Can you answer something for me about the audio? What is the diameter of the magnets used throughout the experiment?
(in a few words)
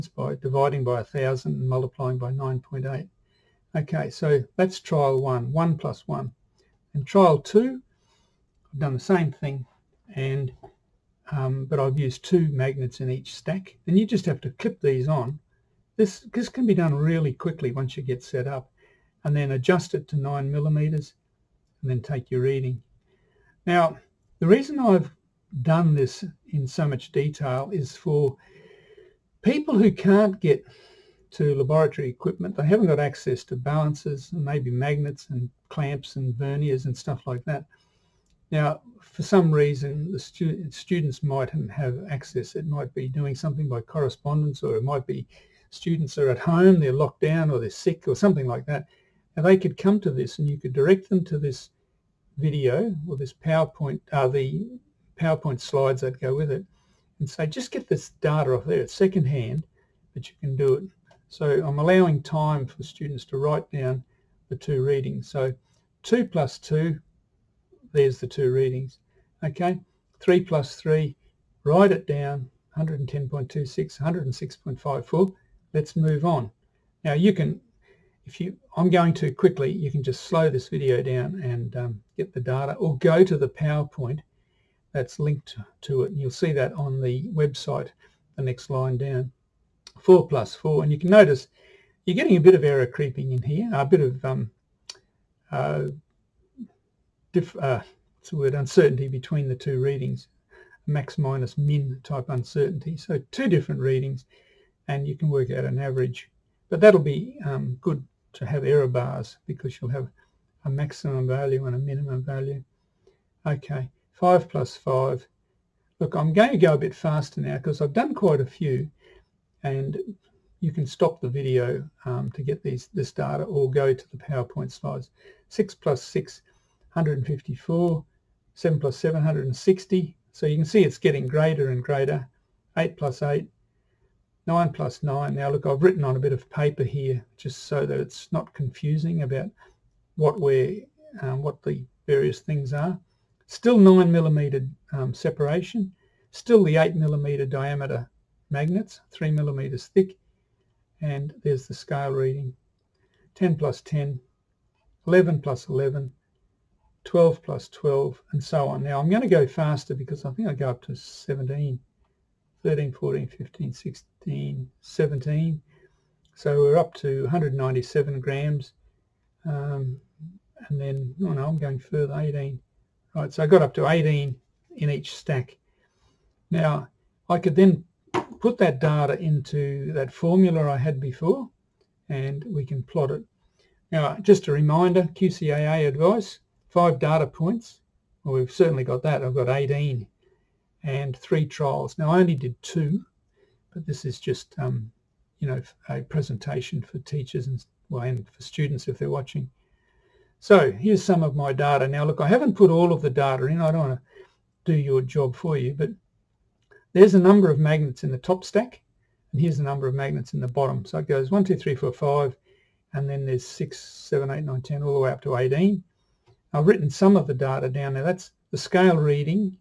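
8 millimeters.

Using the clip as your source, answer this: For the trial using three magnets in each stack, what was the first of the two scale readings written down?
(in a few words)
110.26.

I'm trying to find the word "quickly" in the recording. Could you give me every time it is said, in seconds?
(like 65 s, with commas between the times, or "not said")
17 s, 79 s.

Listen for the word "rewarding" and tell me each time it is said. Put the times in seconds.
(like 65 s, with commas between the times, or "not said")
not said.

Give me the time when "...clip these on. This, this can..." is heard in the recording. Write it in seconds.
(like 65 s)
14 s.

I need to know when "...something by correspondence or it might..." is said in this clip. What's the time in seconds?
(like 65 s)
43 s.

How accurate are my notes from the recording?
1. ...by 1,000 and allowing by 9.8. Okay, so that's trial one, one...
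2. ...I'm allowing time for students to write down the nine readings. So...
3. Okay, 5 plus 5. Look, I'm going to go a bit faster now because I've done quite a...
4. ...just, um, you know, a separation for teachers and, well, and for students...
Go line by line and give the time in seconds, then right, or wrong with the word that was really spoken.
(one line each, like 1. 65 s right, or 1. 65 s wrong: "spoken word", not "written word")
1. 0 s wrong: "multiplying", not "allowing"
2. 61 s wrong: "two", not "nine"
3. 113 s right
4. 194 s wrong: "presentation", not "separation".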